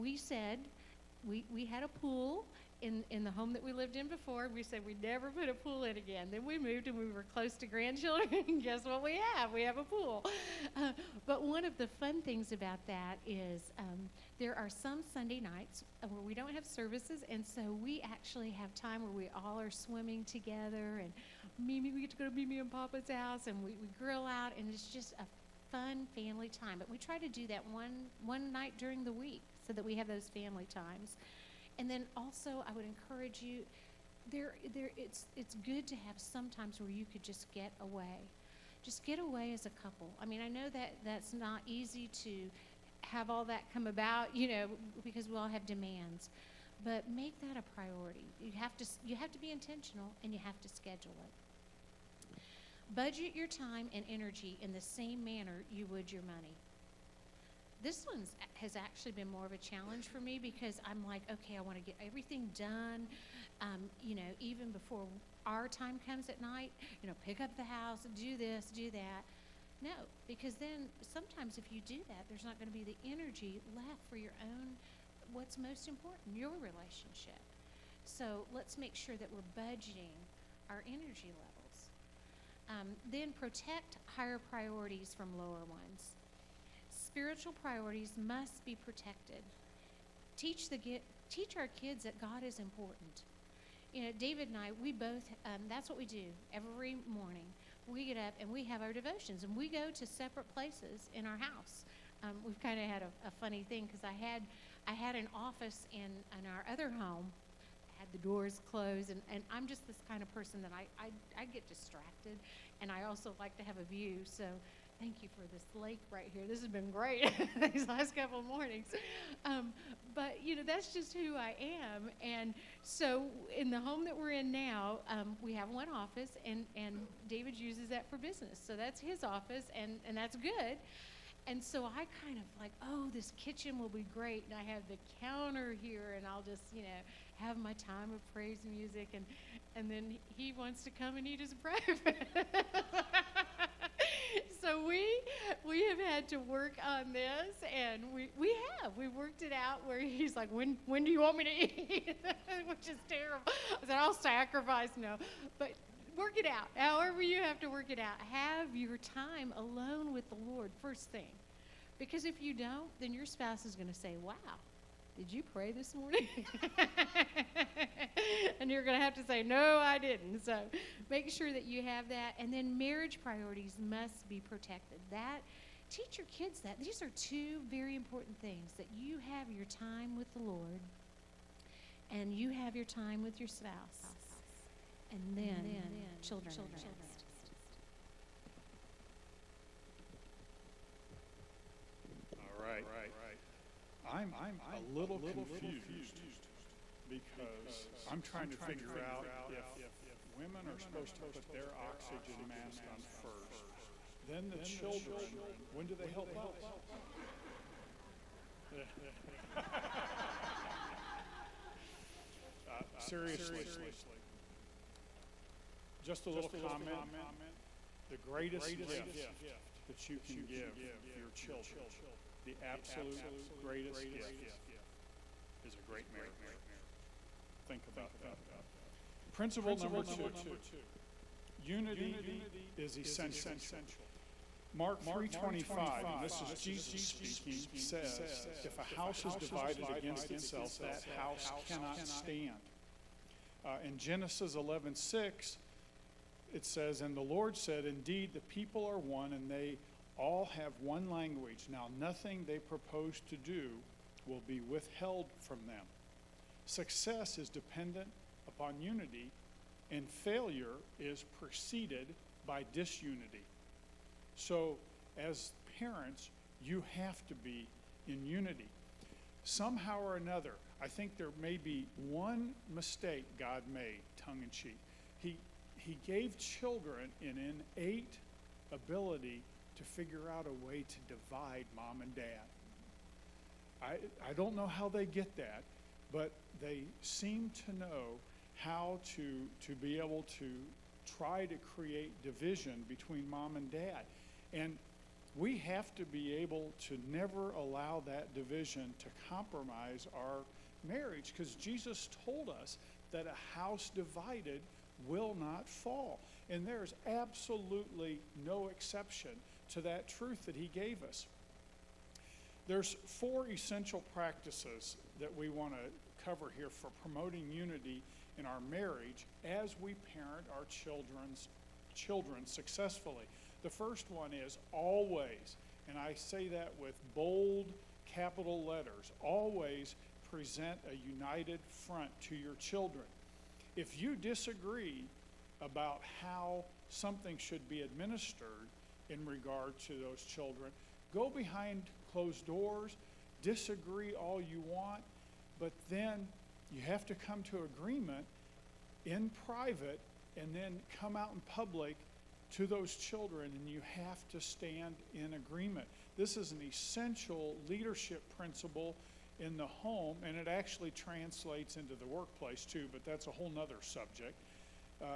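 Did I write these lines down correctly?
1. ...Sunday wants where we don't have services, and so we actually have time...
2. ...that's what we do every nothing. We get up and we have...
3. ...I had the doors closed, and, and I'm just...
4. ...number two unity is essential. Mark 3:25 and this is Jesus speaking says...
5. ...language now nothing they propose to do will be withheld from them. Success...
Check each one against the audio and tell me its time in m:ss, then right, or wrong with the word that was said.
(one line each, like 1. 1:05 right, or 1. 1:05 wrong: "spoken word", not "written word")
1. 0:15 wrong: "nights", not "wants"
2. 1:35 wrong: "morning", not "nothing"
3. 1:47 right
4. 3:49 right
5. 4:11 right.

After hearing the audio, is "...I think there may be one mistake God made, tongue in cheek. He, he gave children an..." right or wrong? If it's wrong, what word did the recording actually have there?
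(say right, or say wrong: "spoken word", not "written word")
right.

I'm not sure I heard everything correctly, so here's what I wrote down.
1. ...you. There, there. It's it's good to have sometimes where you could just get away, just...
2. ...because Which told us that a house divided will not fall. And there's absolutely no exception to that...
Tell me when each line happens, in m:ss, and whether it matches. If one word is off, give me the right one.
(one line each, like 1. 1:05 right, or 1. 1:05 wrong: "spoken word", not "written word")
1. 0:33 right
2. 5:01 wrong: "Jesus", not "Which".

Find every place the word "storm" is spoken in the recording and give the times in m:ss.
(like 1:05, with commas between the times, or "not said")
not said.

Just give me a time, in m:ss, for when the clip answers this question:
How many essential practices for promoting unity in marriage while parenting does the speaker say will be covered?
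5:13.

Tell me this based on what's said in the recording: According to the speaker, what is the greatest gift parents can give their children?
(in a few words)
A great marriage.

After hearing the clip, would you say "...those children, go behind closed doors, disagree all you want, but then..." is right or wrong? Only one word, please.
right.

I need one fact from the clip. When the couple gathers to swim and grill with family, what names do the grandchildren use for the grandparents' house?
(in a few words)
Mimi and Papa's house.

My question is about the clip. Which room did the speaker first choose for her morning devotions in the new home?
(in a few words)
Kitchen.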